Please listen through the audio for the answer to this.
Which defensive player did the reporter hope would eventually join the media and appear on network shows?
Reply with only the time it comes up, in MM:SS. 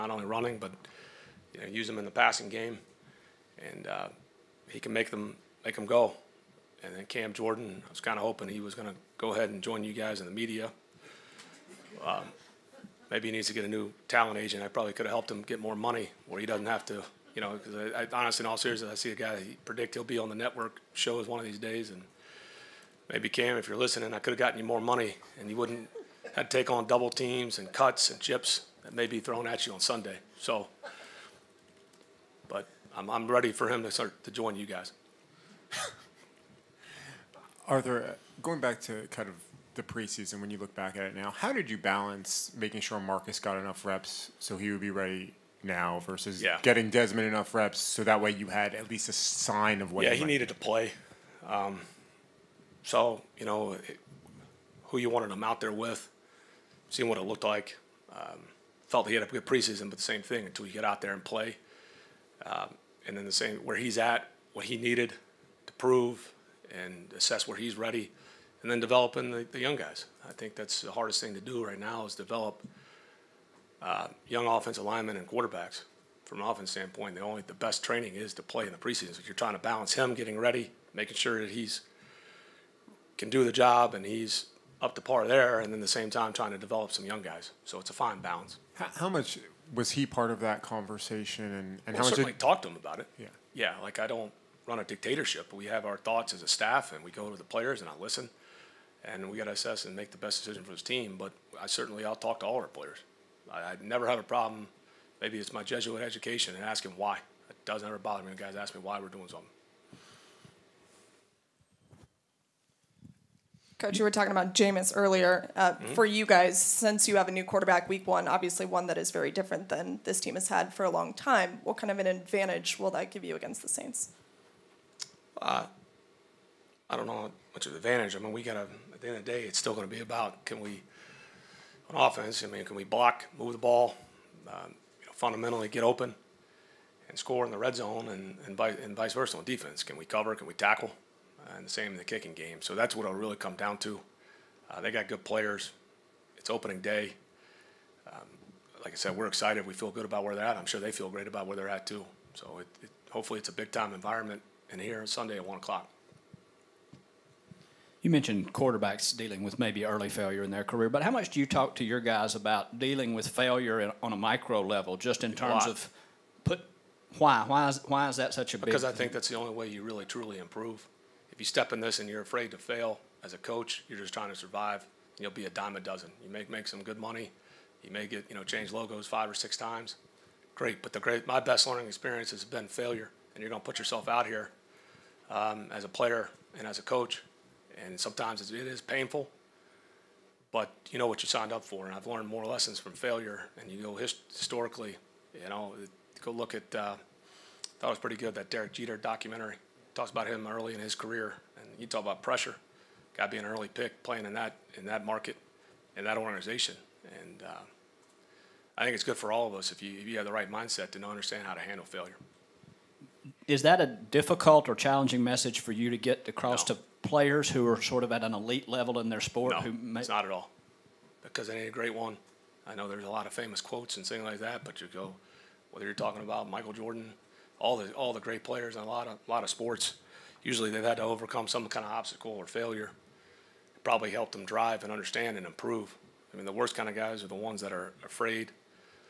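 00:07.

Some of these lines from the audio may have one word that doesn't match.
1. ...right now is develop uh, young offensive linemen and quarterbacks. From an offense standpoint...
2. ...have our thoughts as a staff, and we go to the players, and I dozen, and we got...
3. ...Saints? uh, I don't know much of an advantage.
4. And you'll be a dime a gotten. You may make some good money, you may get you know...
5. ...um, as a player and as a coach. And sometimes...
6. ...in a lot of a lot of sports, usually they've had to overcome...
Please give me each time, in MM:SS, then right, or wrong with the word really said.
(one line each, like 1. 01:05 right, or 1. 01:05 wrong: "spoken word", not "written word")
1. 01:11 right
2. 01:35 wrong: "listen", not "dozen"
3. 02:03 right
4. 02:54 wrong: "dozen", not "gotten"
5. 03:05 right
6. 03:48 right.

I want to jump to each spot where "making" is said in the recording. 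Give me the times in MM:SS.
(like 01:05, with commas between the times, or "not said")
00:42, 01:20.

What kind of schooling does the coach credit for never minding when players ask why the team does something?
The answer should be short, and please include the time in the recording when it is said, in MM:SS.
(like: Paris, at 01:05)
Jesuit education, at 01:45.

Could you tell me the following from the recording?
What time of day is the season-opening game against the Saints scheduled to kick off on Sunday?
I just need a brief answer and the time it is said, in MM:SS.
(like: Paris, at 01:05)
1 o'clock, at 02:35.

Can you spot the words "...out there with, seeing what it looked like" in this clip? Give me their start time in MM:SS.
00:55.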